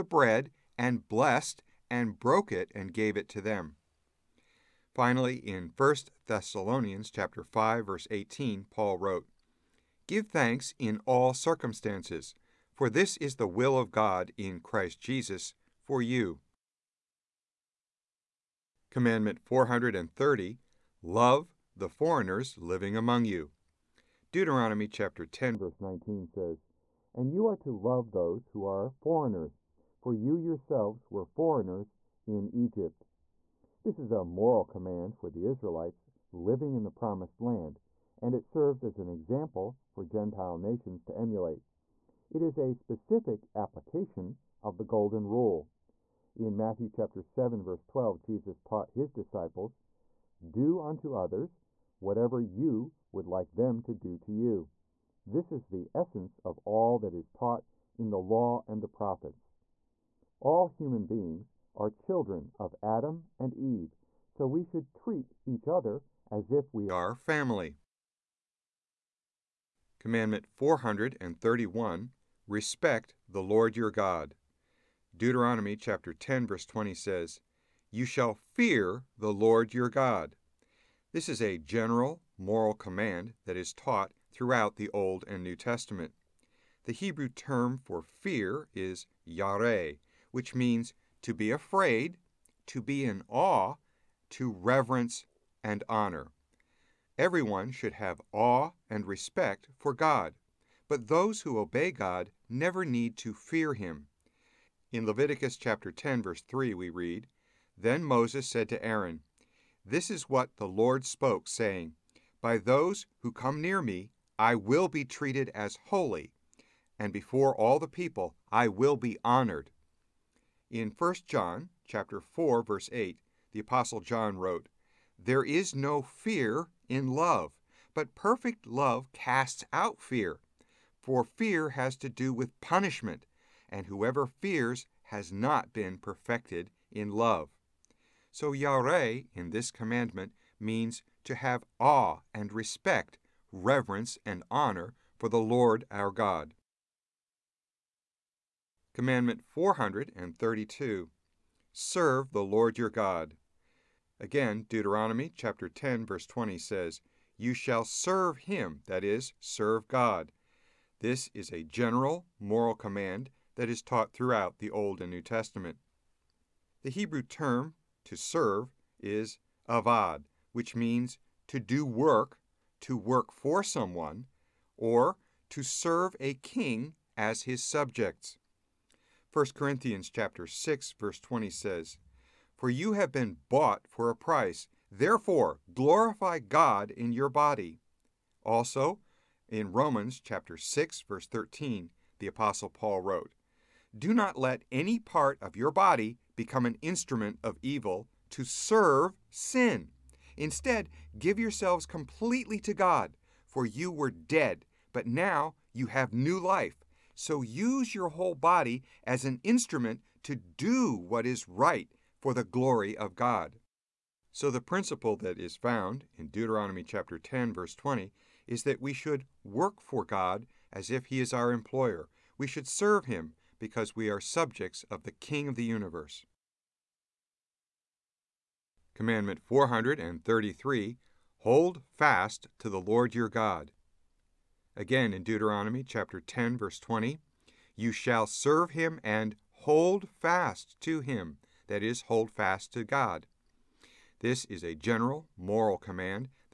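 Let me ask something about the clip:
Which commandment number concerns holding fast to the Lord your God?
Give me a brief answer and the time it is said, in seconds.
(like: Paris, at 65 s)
433, at 228 s.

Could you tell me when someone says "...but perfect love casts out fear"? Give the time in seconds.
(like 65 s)
127 s.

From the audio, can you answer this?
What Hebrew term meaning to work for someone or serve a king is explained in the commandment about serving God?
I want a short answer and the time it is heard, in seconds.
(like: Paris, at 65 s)
avad, at 169 s.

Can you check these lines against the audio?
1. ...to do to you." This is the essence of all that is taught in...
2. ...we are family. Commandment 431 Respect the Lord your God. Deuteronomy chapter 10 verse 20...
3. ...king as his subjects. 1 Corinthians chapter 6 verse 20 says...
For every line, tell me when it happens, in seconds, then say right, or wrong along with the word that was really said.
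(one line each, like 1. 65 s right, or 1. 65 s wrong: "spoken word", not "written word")
1. 53 s right
2. 66 s right
3. 176 s right.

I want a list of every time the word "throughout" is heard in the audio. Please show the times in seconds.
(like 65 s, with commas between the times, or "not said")
84 s, 164 s.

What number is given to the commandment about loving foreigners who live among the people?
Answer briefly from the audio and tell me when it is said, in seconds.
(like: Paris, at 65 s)
430, at 18 s.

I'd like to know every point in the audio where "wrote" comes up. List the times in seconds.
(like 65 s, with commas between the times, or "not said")
8 s, 124 s, 193 s.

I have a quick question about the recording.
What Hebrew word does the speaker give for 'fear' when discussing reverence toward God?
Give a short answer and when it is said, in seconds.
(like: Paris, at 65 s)
yareh, at 89 s.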